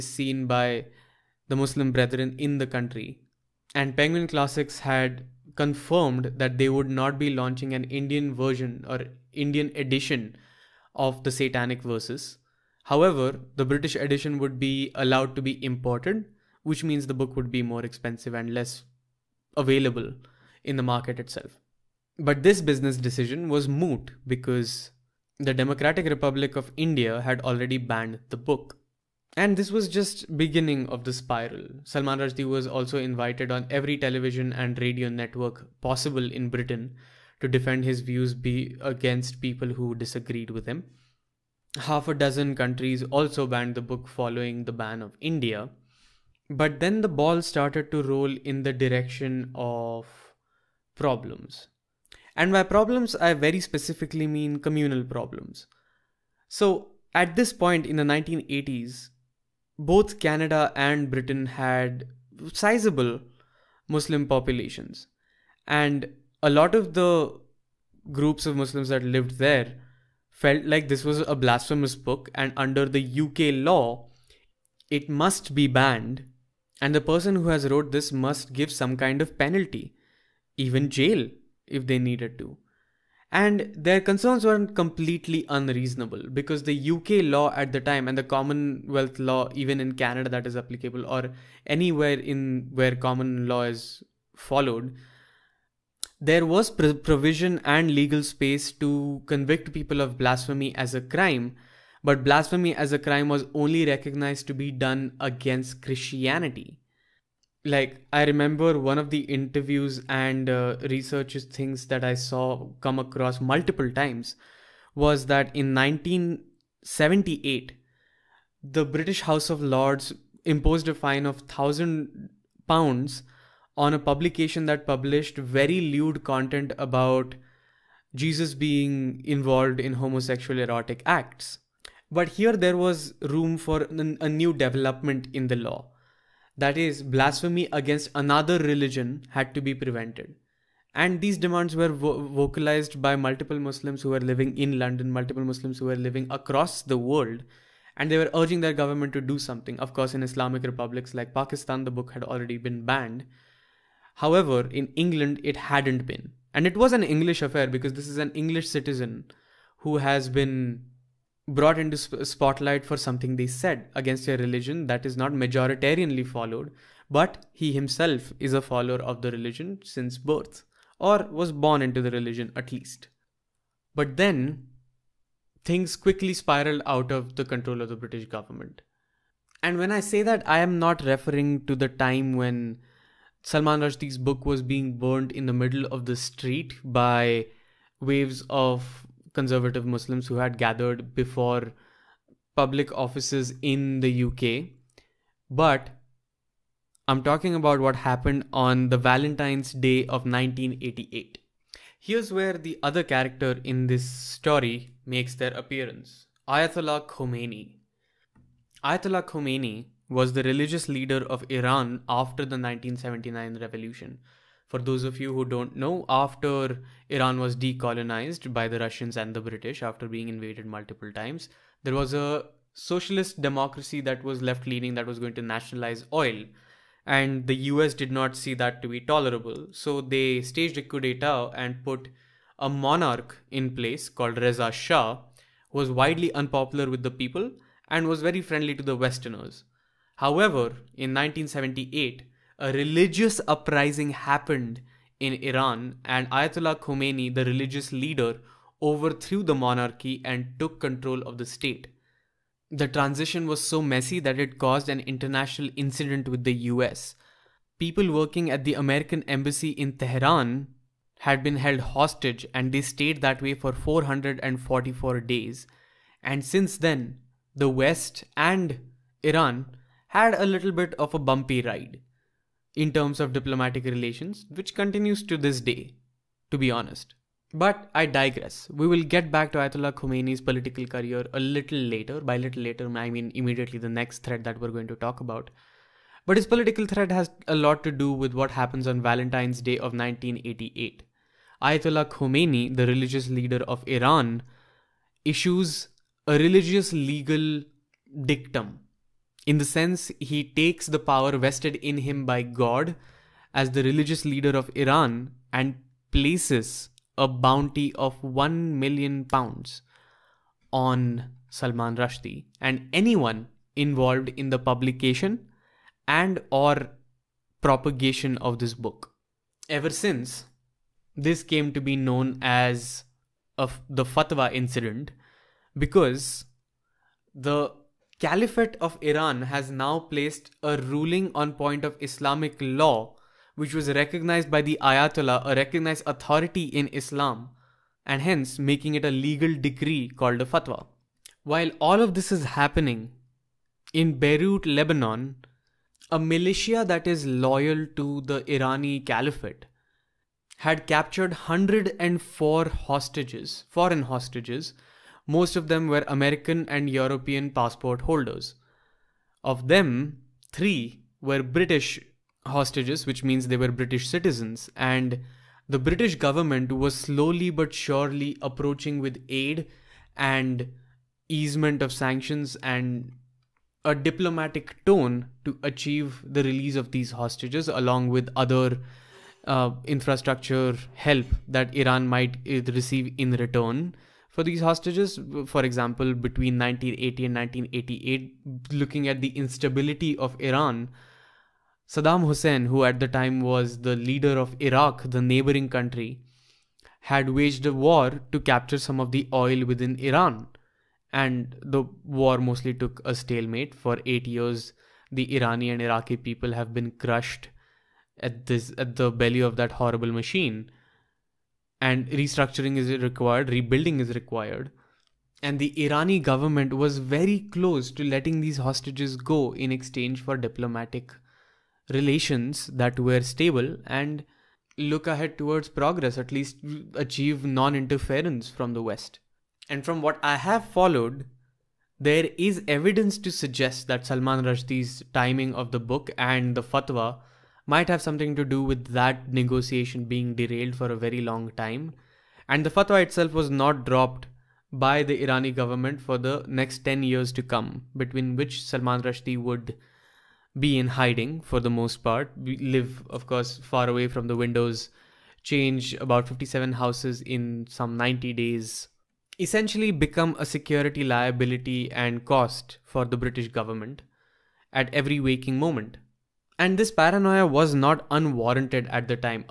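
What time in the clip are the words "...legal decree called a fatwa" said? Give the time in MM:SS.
05:39.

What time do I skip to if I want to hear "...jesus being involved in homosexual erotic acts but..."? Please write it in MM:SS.
02:08.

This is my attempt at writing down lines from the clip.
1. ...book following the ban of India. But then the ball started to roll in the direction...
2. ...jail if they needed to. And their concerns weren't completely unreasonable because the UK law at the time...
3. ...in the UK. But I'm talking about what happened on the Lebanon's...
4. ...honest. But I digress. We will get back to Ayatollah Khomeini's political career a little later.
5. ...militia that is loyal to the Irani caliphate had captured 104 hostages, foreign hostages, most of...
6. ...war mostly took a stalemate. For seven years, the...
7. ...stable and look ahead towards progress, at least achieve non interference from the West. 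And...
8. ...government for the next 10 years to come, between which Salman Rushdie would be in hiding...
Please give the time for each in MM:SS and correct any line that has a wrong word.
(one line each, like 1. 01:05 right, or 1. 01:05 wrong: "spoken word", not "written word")
1. 00:43 right
2. 01:20 right
3. 03:13 wrong: "Valentine", not "Lebanon"
4. 04:36 right
5. 05:46 right
6. 06:42 wrong: "eight", not "seven"
7. 07:03 right
8. 07:25 right.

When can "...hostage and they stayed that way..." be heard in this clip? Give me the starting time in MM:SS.
04:21.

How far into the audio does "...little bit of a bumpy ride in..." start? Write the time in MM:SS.
04:30.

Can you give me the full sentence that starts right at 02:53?
But then, things quickly spiraled out of the control of the British government.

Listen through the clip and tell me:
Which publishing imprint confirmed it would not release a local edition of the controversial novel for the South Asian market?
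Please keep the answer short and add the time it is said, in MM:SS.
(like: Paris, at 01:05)
Penguin Classics, at 00:03.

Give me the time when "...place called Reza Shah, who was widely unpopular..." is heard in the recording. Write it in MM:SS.
03:53.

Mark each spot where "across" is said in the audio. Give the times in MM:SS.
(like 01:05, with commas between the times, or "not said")
01:52, 02:26.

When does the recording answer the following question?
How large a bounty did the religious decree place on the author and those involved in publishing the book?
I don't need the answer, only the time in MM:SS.
05:08.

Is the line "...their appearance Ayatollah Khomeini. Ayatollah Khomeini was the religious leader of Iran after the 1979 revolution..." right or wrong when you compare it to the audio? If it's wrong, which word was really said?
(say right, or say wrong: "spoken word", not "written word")
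right.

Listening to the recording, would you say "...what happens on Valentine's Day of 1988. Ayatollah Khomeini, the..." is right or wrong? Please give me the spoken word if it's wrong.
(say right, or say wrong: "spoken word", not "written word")
right.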